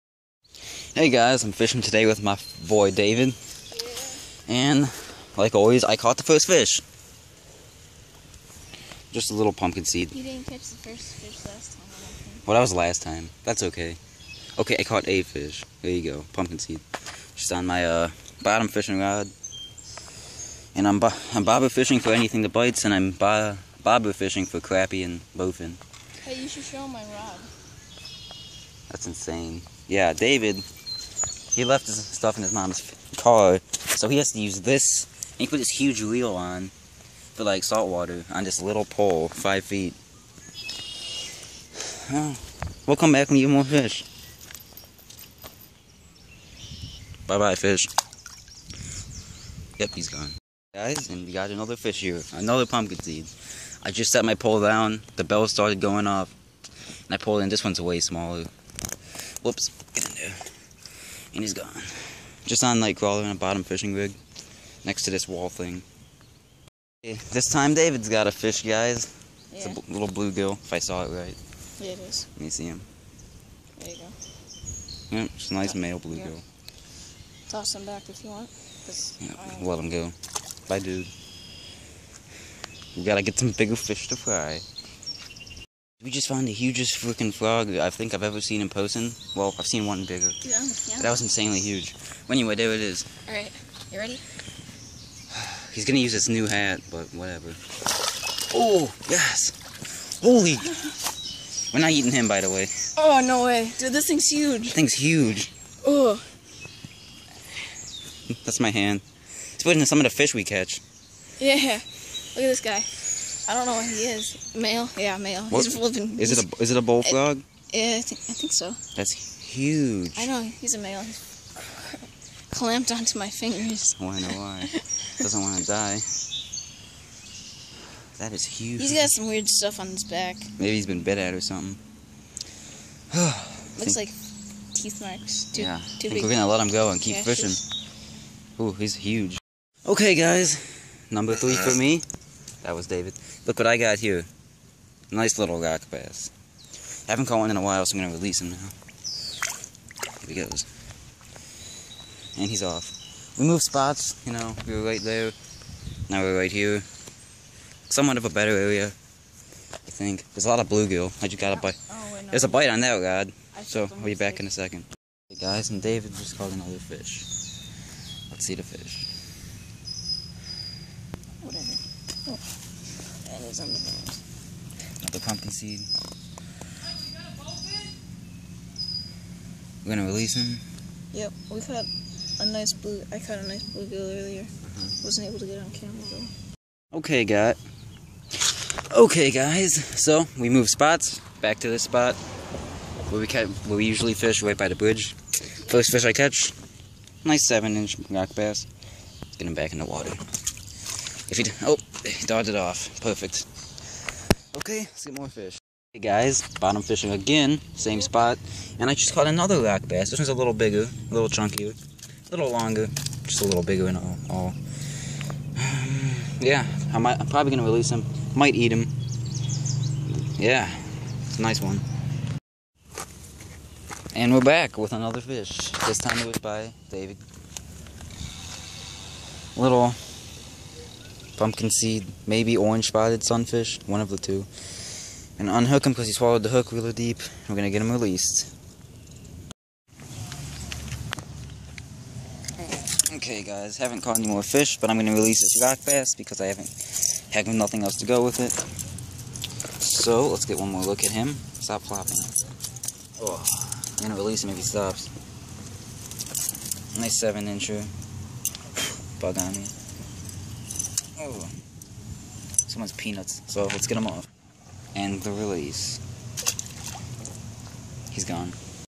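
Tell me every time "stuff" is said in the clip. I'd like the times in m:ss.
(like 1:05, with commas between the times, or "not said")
0:31, 2:09.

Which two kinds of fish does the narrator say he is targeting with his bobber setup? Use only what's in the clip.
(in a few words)
Crappie and bowfin.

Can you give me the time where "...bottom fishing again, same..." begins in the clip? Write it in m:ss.
3:26.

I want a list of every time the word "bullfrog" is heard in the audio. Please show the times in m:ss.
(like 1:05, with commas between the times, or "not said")
1:56.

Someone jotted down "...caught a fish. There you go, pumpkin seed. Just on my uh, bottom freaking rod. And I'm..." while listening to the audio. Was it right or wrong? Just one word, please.
wrong.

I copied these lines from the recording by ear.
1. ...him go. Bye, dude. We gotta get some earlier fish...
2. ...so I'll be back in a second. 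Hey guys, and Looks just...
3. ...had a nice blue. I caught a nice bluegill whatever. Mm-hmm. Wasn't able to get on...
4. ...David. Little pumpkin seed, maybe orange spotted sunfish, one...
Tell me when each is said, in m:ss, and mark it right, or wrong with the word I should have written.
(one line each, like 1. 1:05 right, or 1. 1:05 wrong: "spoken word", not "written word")
1. 1:19 wrong: "bigger", not "earlier"
2. 2:43 wrong: "David", not "Looks"
3. 3:01 wrong: "earlier", not "whatever"
4. 3:46 right.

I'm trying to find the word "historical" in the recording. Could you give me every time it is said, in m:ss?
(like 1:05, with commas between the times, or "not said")
not said.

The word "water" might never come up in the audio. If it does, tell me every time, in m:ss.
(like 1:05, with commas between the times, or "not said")
0:37, 3:19.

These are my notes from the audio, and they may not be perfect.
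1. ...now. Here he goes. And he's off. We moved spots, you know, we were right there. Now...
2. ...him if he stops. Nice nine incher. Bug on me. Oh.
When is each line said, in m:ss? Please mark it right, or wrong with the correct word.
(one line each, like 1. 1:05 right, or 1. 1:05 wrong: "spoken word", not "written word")
1. 2:28 right
2. 4:14 wrong: "seven", not "nine".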